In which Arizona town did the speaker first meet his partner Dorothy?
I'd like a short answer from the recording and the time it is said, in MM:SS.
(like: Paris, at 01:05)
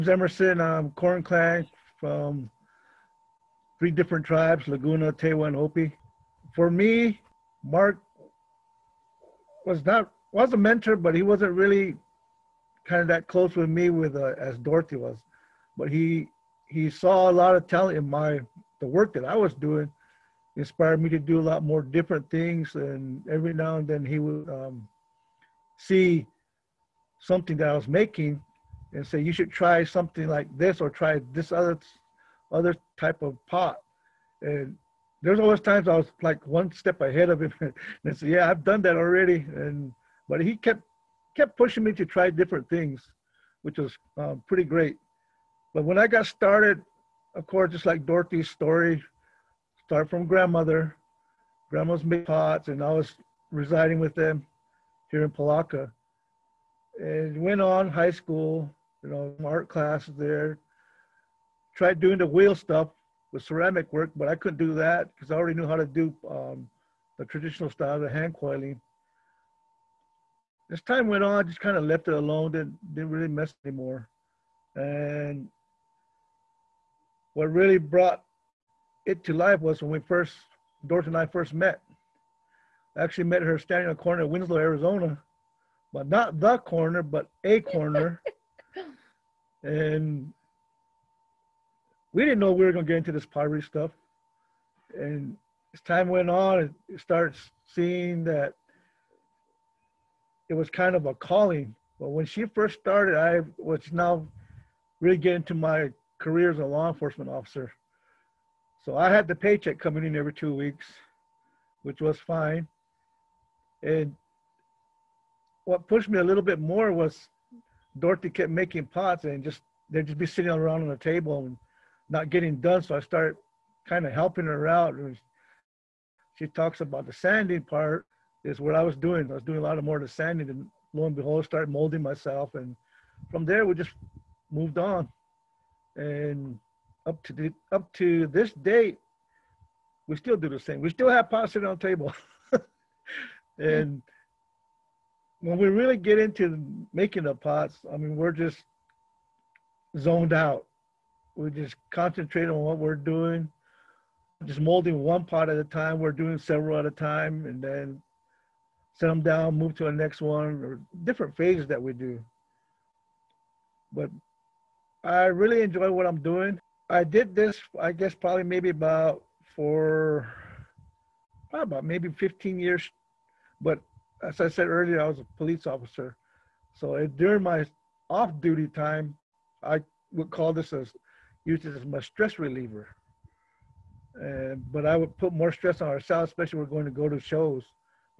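Winslow, at 01:24.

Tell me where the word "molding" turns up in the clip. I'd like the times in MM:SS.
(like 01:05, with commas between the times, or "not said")
02:11, 02:34.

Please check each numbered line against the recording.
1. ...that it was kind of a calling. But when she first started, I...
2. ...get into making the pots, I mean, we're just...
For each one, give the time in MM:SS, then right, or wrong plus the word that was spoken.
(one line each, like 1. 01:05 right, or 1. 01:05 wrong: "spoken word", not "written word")
1. 01:38 right
2. 02:25 right.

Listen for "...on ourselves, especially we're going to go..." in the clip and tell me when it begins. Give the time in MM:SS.
03:05.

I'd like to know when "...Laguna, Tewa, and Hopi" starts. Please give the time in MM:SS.
00:04.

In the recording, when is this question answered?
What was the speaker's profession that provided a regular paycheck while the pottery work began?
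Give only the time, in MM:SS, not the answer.
01:46.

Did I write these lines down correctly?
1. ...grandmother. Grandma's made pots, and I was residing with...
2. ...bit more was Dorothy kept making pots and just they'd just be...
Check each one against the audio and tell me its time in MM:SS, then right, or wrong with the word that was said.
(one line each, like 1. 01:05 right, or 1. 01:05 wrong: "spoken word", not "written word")
1. 00:50 right
2. 01:56 right.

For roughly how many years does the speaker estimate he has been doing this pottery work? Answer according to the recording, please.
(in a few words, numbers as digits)
15.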